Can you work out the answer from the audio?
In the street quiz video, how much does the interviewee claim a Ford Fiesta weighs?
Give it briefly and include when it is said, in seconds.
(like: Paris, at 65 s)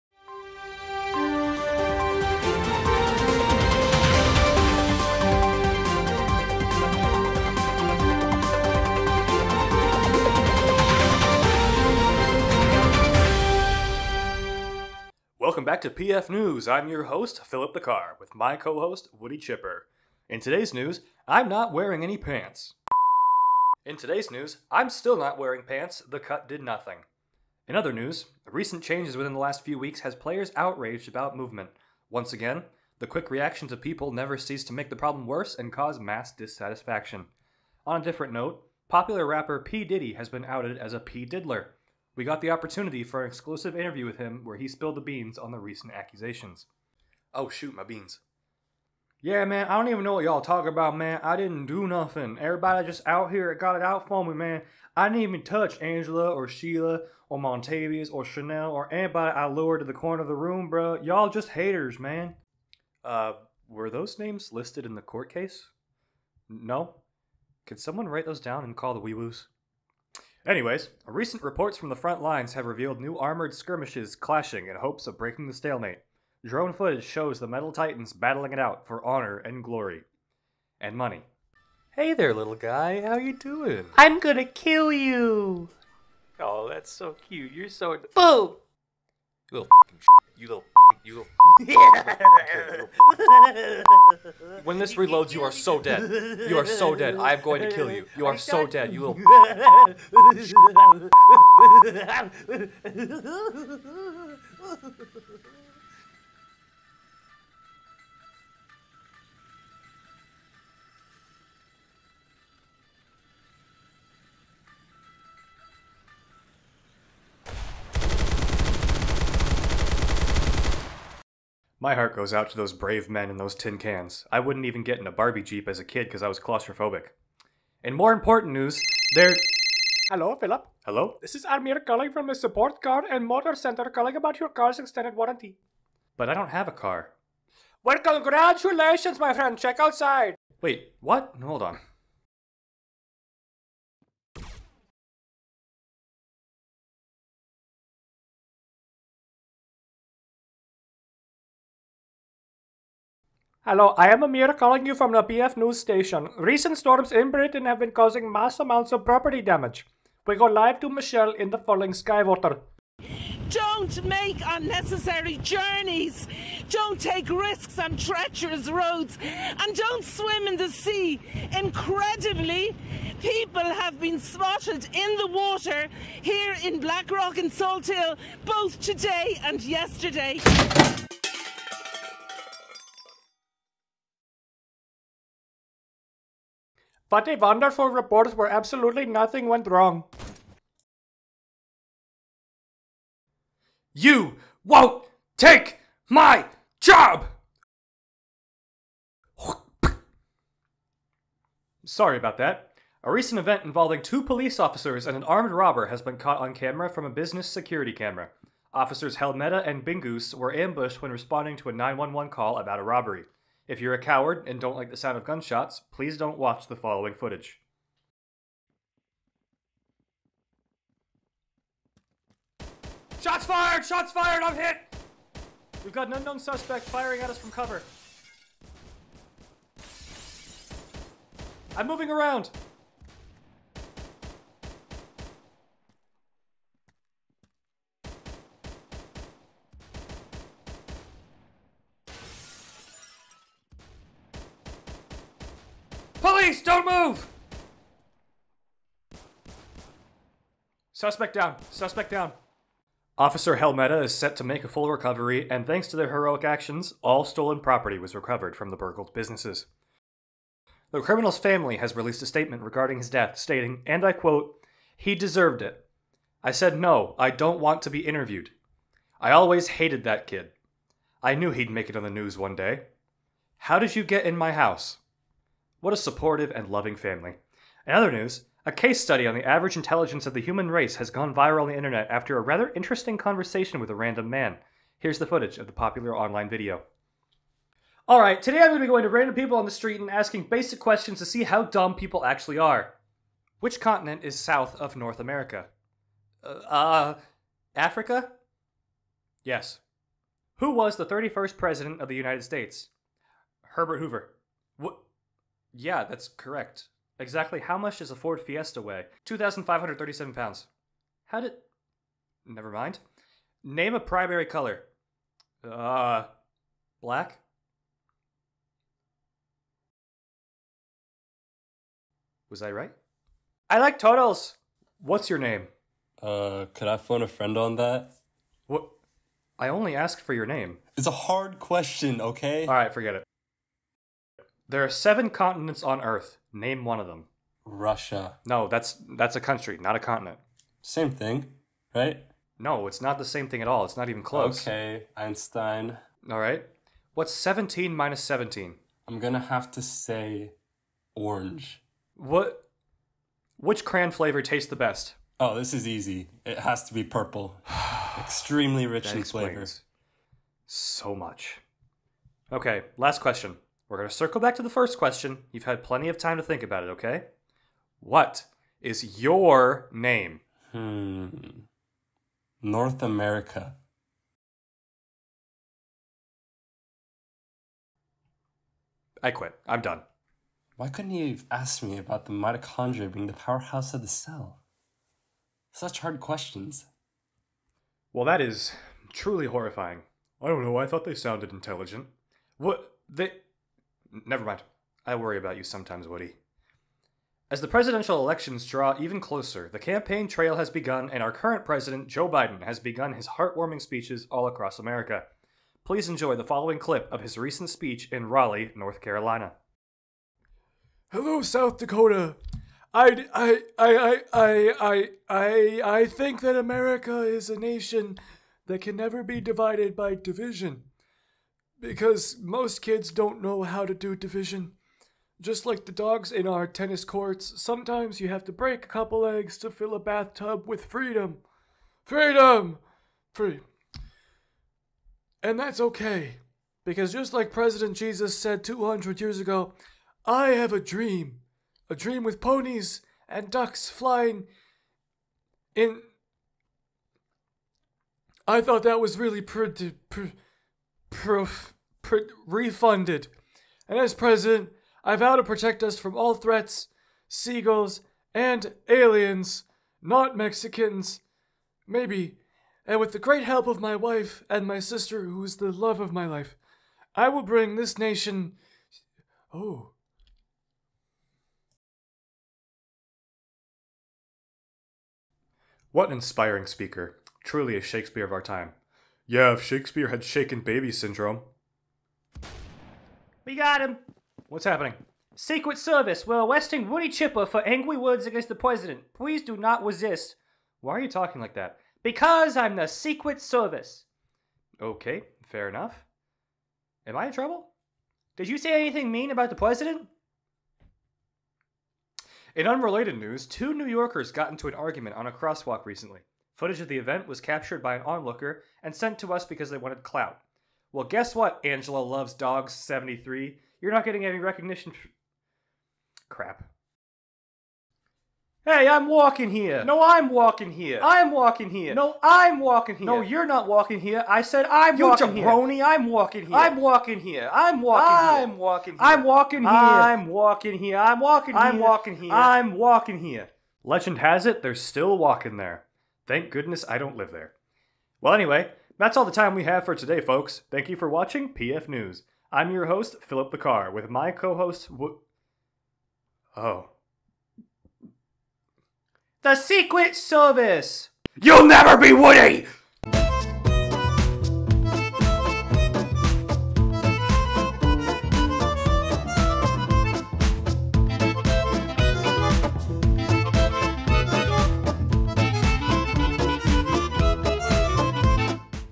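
2,537 pounds, at 309 s.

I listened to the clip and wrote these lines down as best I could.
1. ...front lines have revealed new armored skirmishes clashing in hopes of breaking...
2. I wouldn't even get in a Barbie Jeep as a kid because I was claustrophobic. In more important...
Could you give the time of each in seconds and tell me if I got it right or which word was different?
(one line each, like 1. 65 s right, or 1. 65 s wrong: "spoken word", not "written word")
1. 71 s right
2. 124 s right.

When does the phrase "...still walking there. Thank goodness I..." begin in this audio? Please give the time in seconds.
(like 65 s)
534 s.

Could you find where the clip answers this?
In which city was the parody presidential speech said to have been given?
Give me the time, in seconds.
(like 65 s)
408 s.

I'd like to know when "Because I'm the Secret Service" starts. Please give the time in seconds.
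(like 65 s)
492 s.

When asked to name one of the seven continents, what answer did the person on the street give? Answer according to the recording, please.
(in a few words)
Russia.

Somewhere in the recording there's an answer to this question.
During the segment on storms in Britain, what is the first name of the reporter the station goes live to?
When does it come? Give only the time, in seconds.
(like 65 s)
160 s.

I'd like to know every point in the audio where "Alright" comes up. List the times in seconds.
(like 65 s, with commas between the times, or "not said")
288 s, 332 s.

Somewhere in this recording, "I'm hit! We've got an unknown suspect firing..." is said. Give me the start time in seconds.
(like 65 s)
224 s.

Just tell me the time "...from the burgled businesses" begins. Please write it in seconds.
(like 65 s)
258 s.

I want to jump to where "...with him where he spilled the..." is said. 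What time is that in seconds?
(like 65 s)
44 s.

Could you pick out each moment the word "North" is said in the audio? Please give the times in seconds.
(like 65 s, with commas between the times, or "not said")
294 s, 372 s, 408 s.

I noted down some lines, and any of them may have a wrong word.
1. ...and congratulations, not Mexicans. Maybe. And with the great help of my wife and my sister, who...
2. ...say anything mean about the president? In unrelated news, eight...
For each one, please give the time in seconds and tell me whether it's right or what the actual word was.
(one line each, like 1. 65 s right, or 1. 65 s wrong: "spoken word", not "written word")
1. 458 s wrong: "aliens", not "congratulations"
2. 498 s wrong: "two", not "eight".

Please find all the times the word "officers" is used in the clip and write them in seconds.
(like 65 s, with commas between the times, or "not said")
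204 s, 208 s, 253 s.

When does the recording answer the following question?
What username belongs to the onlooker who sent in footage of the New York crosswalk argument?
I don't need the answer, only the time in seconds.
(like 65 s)
511 s.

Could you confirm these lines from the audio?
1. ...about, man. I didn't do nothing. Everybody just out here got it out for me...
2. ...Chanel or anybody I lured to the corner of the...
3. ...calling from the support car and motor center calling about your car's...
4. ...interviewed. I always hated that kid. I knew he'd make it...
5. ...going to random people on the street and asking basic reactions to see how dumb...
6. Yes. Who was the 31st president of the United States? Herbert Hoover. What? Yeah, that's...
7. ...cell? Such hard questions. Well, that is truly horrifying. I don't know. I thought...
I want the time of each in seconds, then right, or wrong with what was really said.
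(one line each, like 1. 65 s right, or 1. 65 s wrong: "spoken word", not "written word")
1. 50 s right
2. 58 s right
3. 131 s right
4. 268 s right
5. 288 s wrong: "questions", not "reactions"
6. 299 s right
7. 384 s right.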